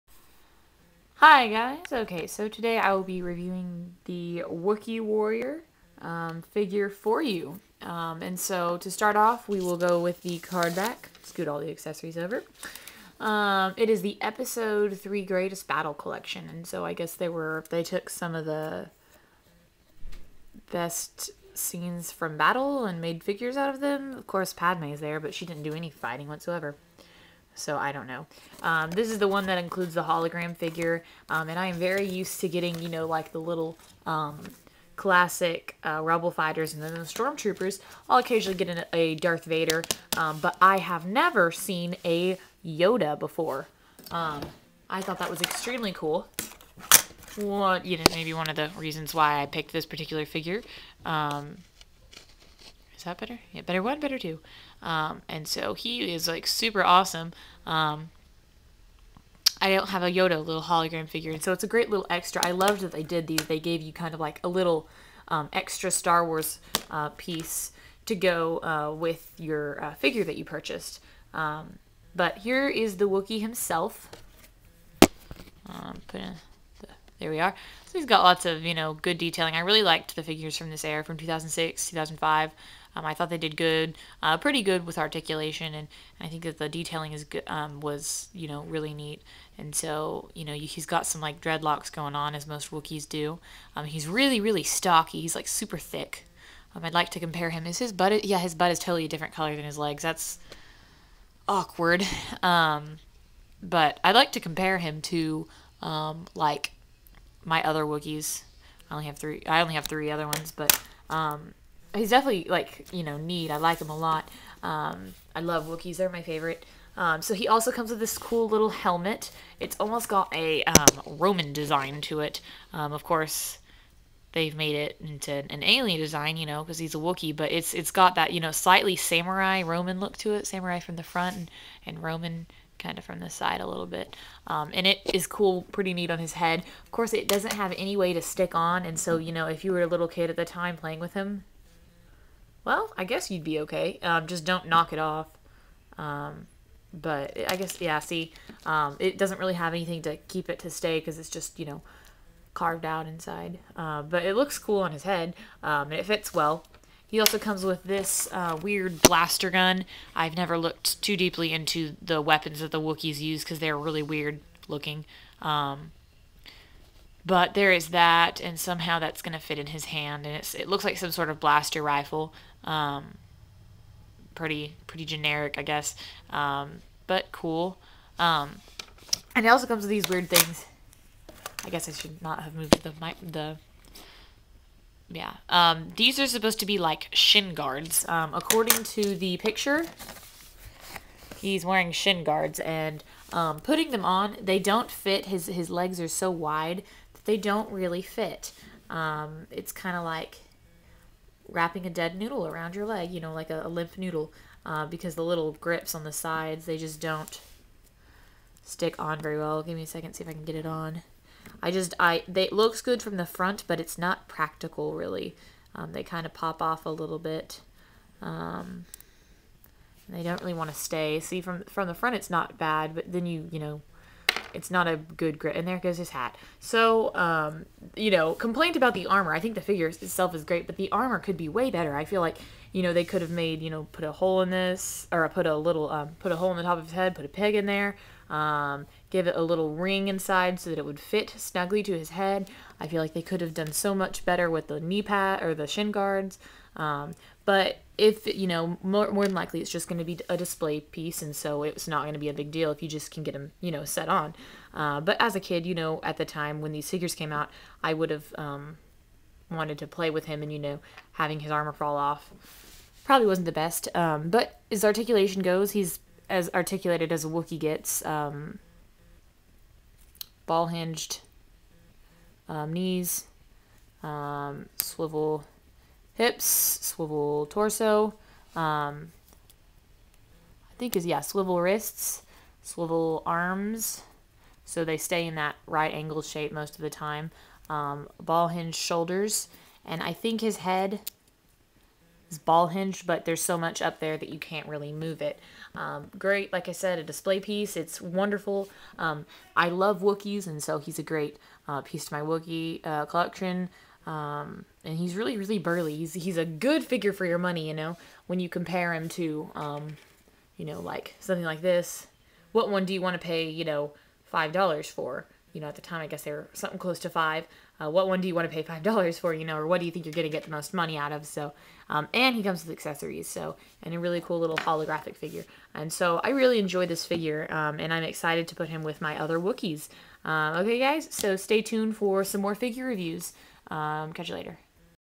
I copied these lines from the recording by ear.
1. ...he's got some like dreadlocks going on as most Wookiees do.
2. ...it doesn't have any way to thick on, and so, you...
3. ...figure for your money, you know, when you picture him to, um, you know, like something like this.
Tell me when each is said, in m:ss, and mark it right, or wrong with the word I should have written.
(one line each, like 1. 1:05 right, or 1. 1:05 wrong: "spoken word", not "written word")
1. 1:30 right
2. 2:17 wrong: "stick", not "thick"
3. 5:06 wrong: "compare", not "picture".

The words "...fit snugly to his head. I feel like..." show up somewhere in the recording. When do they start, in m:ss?
4:00.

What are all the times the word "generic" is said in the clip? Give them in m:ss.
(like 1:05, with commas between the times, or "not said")
2:55.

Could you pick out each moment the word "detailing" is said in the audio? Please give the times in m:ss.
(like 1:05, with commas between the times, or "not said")
1:19, 1:26.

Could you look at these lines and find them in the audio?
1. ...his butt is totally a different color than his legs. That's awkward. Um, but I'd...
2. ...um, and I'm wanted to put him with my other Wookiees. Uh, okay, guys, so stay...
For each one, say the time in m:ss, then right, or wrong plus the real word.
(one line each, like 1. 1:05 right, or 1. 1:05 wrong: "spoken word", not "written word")
1. 1:38 right
2. 5:27 wrong: "excited", not "wanted".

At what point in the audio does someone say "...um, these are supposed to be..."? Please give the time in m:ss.
3:05.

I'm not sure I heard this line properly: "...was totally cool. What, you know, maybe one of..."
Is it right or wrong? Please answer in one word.
wrong.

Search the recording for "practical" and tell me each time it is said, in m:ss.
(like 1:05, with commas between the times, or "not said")
3:34.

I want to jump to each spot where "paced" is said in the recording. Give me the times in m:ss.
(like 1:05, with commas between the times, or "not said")
not said.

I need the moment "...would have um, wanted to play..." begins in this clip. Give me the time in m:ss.
4:17.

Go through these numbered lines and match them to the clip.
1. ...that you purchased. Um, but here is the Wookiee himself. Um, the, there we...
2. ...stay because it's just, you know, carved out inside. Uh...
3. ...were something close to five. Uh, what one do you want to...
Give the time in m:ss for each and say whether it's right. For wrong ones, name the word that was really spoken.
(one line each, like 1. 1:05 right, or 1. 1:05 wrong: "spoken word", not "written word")
1. 1:10 right
2. 2:30 right
3. 5:16 right.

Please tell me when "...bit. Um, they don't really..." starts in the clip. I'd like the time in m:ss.
3:37.